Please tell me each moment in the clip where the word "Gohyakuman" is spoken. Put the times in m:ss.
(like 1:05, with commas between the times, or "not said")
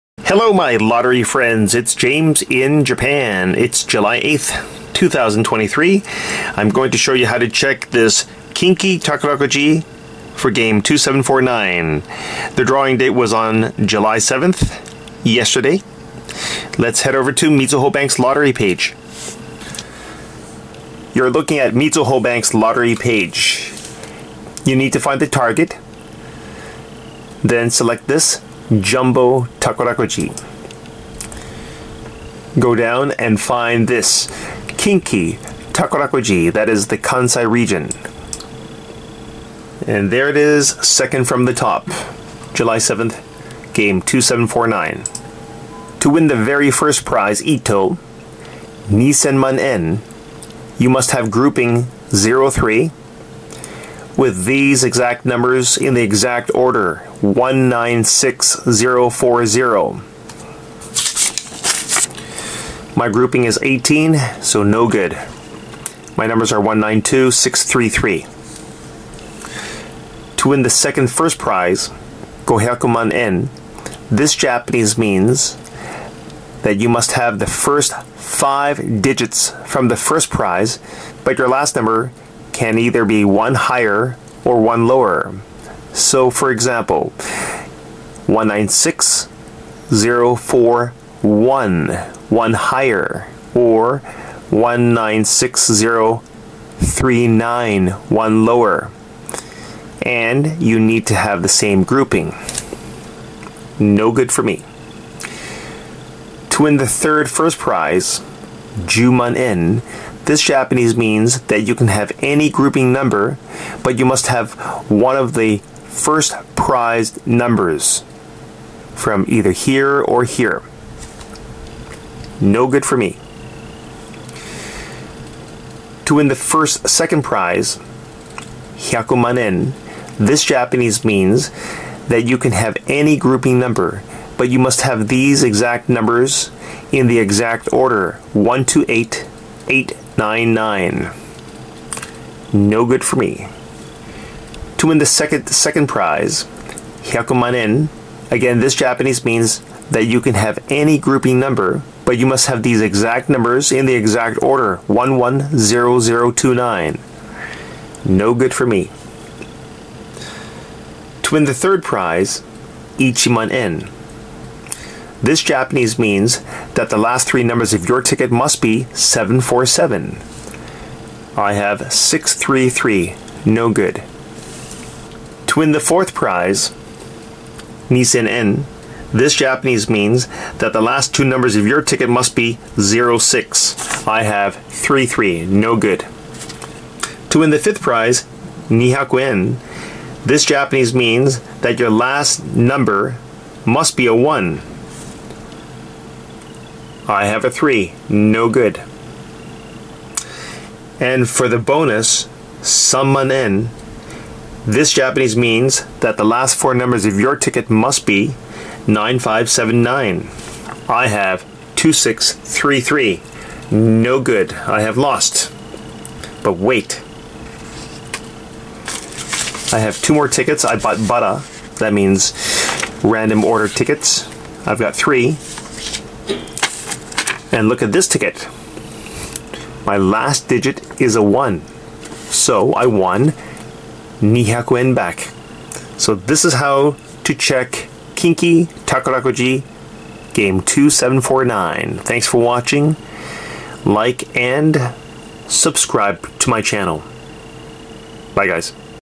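1:12.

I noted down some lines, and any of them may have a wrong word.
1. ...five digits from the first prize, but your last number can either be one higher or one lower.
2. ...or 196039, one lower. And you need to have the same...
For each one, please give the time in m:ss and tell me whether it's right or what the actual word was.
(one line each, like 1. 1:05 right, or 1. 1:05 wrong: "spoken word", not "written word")
1. 1:18 right
2. 1:33 right.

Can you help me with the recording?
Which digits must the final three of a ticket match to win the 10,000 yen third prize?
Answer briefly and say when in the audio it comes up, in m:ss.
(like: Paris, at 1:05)
747, at 2:48.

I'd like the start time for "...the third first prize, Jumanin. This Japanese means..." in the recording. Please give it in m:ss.
1:46.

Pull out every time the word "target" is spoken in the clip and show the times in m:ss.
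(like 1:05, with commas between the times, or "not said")
0:25.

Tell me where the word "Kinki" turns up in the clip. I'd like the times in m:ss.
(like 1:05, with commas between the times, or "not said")
0:08, 0:34, 3:58.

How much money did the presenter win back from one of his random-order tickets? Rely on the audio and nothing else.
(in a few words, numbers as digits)
200 yen.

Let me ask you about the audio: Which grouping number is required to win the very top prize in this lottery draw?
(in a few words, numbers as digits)
03.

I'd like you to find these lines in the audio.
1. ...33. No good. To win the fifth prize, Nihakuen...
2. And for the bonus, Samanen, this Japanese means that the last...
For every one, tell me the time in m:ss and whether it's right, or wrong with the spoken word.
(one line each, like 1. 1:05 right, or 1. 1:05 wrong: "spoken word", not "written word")
1. 3:04 right
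2. 3:20 right.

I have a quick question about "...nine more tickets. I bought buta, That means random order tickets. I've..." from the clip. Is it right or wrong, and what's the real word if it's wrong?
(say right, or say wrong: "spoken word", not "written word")
wrong: "two", not "nine".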